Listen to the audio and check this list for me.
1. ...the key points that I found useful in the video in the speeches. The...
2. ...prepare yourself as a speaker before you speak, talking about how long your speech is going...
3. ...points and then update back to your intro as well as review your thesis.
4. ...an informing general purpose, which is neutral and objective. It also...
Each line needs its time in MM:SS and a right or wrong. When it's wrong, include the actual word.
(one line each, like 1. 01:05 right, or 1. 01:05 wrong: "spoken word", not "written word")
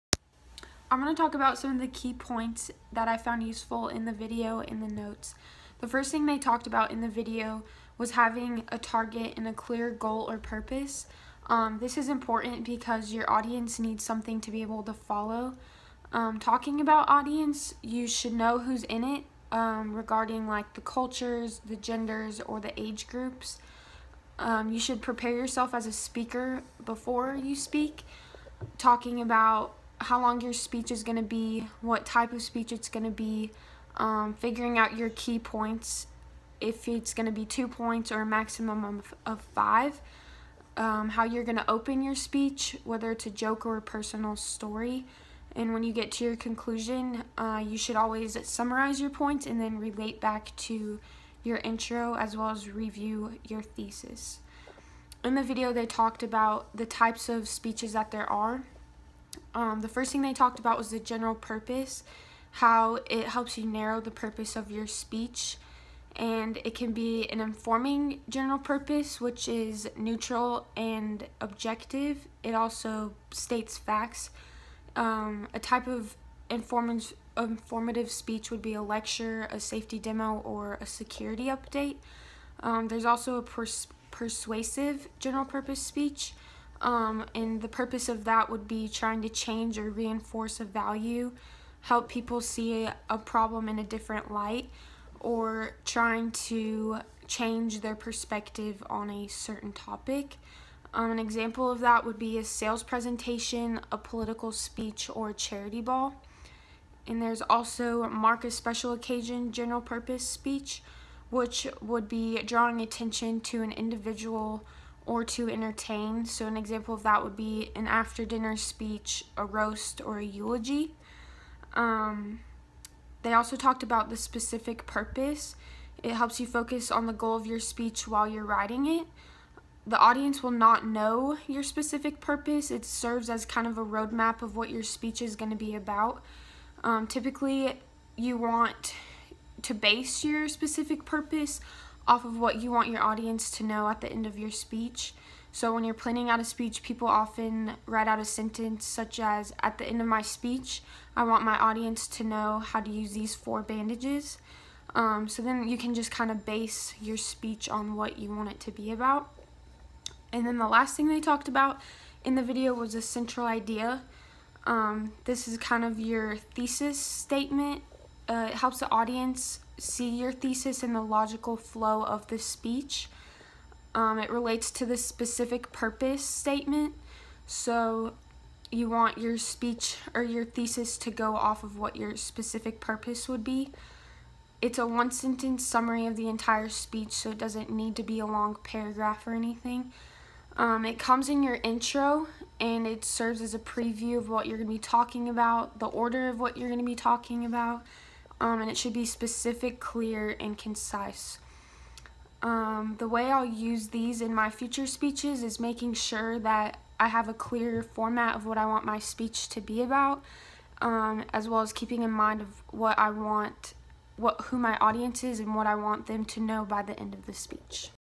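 1. 00:01 wrong: "notes", not "speeches"
2. 00:25 right
3. 00:49 wrong: "relate", not "update"
4. 01:07 right.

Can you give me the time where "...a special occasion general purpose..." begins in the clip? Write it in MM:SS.
01:48.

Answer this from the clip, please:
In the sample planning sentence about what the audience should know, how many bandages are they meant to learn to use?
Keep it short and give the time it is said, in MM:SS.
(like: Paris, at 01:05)
4, at 02:33.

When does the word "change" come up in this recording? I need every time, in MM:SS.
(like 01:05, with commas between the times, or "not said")
01:29, 01:37.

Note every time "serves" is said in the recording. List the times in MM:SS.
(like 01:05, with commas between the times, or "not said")
02:12, 03:13.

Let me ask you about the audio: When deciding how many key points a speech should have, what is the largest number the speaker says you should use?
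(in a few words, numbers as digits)
5.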